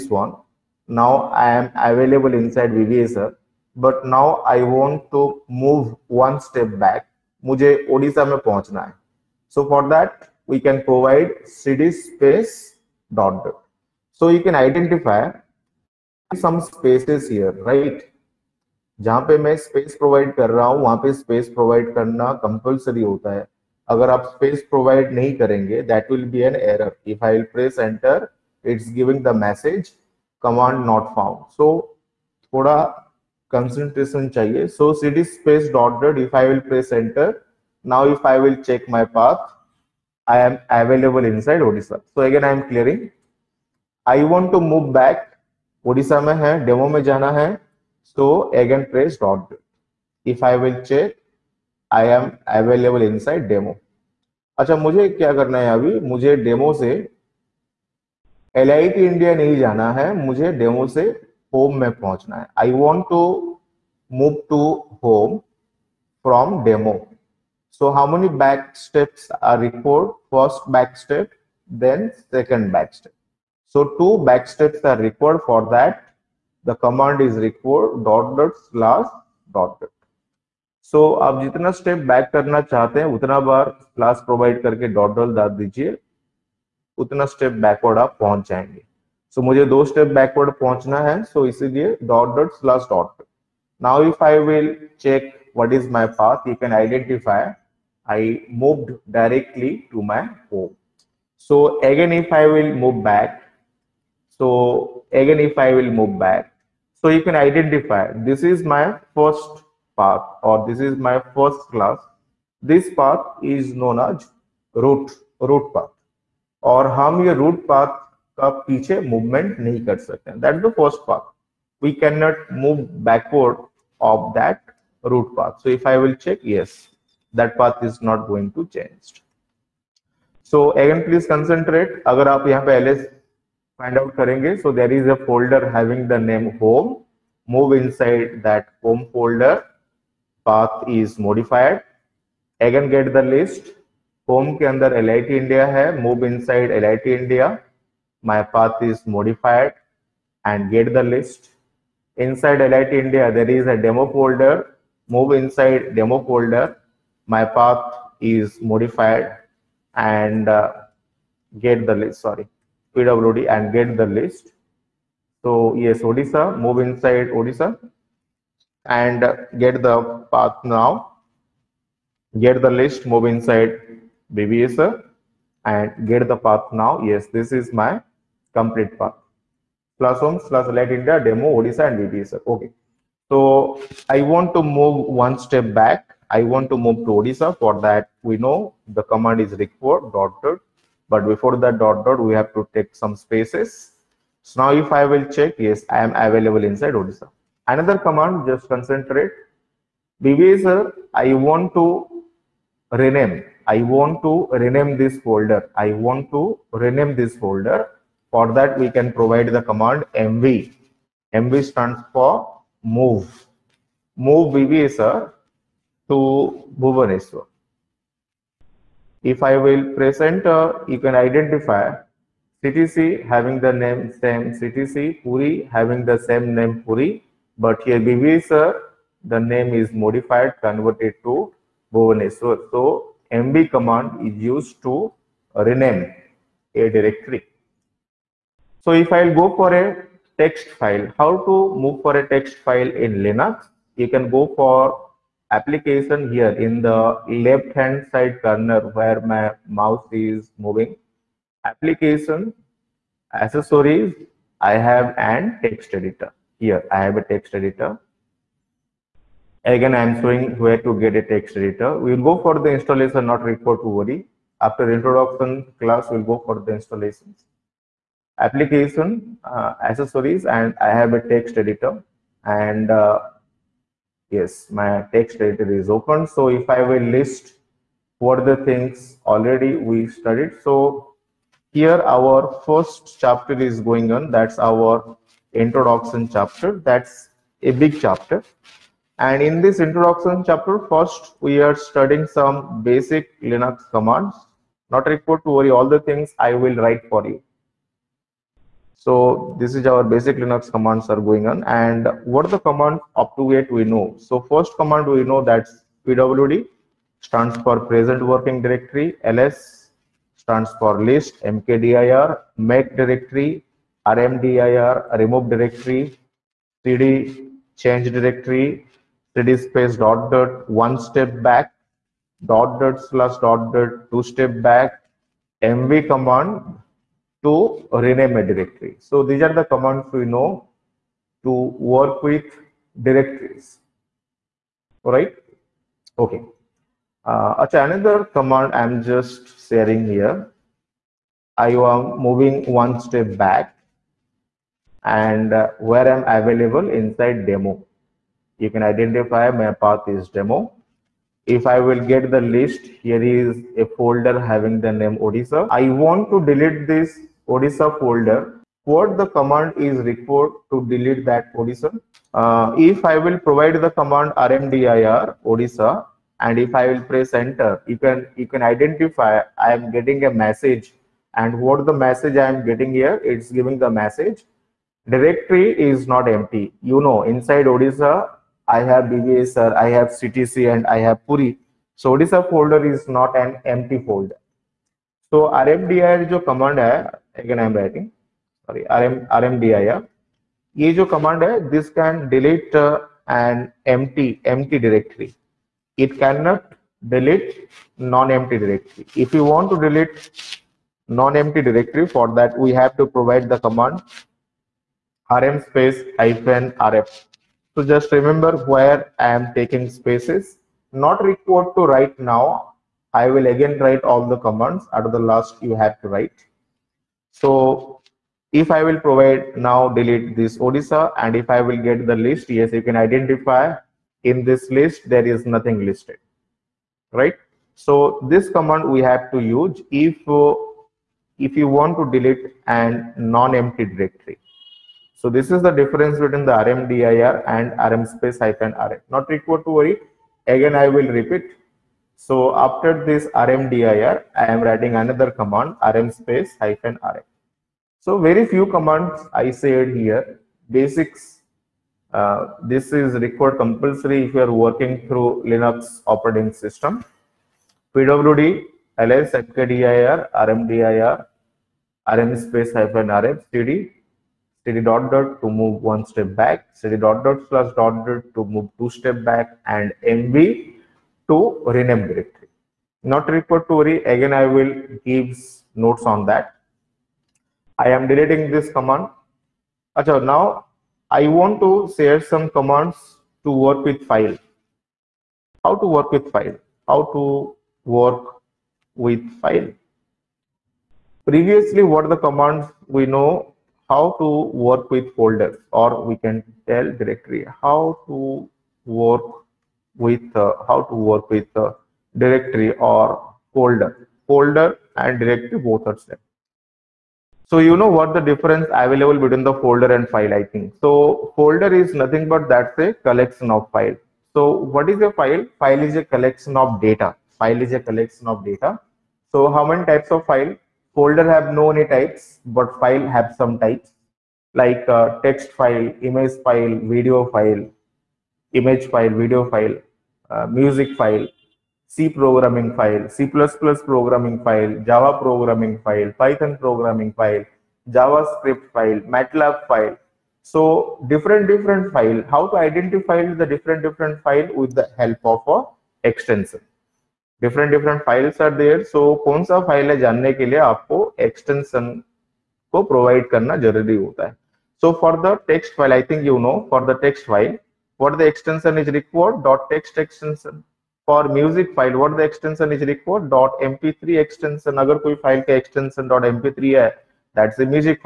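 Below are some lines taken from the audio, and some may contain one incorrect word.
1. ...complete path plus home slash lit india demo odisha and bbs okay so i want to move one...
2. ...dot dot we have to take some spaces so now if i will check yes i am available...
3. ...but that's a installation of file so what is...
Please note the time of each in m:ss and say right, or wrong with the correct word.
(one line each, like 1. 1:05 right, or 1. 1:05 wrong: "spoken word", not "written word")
1. 2:58 right
2. 3:11 right
3. 8:32 wrong: "collection", not "installation".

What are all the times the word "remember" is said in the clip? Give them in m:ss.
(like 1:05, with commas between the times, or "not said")
6:48.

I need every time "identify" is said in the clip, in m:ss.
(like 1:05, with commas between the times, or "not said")
3:41, 5:48, 6:08, 7:02, 9:02.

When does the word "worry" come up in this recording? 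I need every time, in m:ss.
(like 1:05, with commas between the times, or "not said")
4:23, 4:55, 7:19, 7:53.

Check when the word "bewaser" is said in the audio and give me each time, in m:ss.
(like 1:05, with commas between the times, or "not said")
3:20, 3:34.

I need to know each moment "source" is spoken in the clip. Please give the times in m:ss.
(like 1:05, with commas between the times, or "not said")
not said.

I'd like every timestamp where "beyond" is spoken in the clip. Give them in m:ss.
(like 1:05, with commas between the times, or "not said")
not said.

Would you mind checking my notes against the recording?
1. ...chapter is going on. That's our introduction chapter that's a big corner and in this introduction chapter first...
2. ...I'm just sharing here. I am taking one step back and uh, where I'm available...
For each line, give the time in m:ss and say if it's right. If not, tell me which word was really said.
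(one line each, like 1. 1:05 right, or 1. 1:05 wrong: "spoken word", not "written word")
1. 4:43 wrong: "chapter", not "corner"
2. 5:38 wrong: "moving", not "taking".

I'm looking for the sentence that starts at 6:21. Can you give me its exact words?
So Odisha folder is not an empty folder.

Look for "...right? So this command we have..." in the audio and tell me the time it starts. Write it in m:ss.
7:07.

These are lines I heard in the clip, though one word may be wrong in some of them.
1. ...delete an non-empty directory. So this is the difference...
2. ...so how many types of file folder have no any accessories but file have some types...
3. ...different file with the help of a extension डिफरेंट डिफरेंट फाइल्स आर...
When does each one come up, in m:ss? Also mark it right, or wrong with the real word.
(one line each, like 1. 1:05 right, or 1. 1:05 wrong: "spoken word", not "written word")
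1. 7:12 right
2. 8:39 wrong: "types", not "accessories"
3. 9:03 right.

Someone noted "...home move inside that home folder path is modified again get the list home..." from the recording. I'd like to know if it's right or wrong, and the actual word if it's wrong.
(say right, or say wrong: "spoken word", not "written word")
right.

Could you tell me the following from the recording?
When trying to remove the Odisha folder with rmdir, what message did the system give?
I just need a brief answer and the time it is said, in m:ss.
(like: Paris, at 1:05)
directory is not empty, at 6:15.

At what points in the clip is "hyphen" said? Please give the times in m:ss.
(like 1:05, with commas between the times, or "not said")
6:46, 7:18, 7:26, 7:42.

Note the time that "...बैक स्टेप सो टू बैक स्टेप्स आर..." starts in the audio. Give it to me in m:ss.
1:12.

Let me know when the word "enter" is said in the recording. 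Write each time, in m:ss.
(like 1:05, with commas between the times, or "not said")
3:40, 6:07.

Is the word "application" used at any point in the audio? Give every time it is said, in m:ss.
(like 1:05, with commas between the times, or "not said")
4:05, 4:11, 4:28.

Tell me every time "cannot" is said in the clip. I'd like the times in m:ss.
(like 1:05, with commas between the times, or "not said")
2:02, 6:36.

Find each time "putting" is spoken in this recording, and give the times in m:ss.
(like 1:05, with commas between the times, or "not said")
not said.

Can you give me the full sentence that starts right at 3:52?
So MV command is used to rename a directory.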